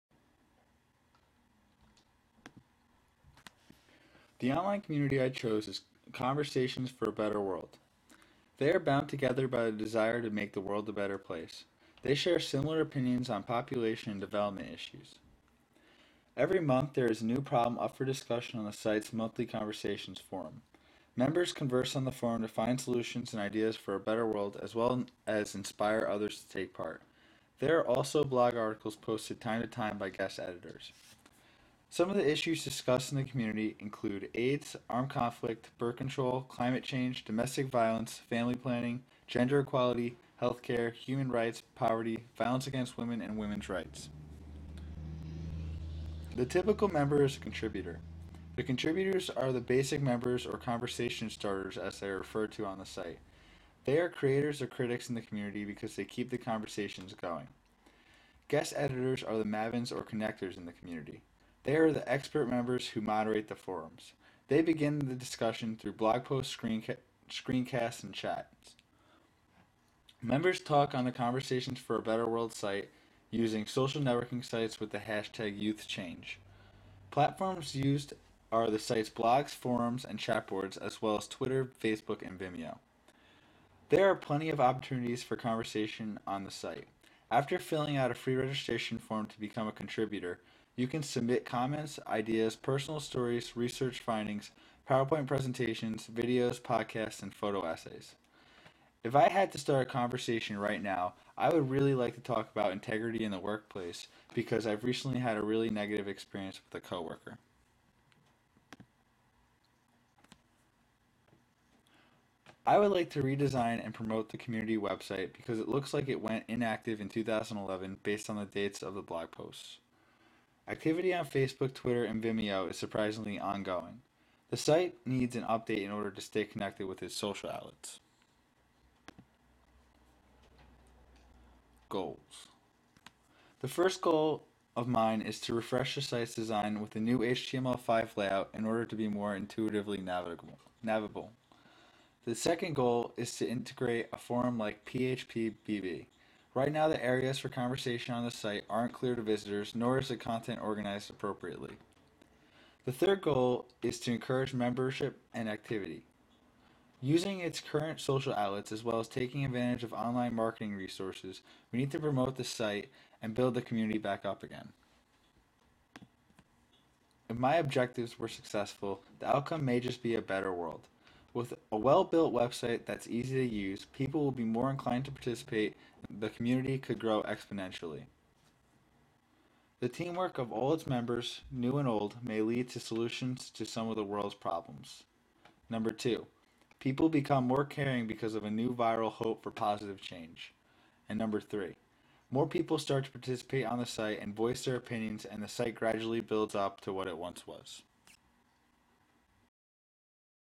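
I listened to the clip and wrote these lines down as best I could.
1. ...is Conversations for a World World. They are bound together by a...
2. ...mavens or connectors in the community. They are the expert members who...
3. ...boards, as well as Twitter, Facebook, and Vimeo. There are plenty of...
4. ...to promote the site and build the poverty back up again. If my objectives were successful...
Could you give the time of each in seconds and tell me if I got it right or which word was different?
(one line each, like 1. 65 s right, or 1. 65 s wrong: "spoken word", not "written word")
1. 5 s wrong: "Better", not "World"
2. 59 s right
3. 80 s right
4. 161 s wrong: "community", not "poverty".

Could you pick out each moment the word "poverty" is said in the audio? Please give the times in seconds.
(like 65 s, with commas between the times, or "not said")
41 s.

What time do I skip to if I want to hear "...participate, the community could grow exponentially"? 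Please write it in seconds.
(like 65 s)
175 s.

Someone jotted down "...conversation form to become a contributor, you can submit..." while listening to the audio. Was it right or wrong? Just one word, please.
wrong.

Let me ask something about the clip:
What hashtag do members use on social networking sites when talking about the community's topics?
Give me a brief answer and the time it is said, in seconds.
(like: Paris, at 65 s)
YouthChange, at 75 s.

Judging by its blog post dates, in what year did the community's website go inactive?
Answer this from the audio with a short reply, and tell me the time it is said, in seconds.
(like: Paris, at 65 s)
2011, at 117 s.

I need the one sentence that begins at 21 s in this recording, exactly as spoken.
Members converse on the forum to find solutions and ideas for a better world as well as inspire others to take part.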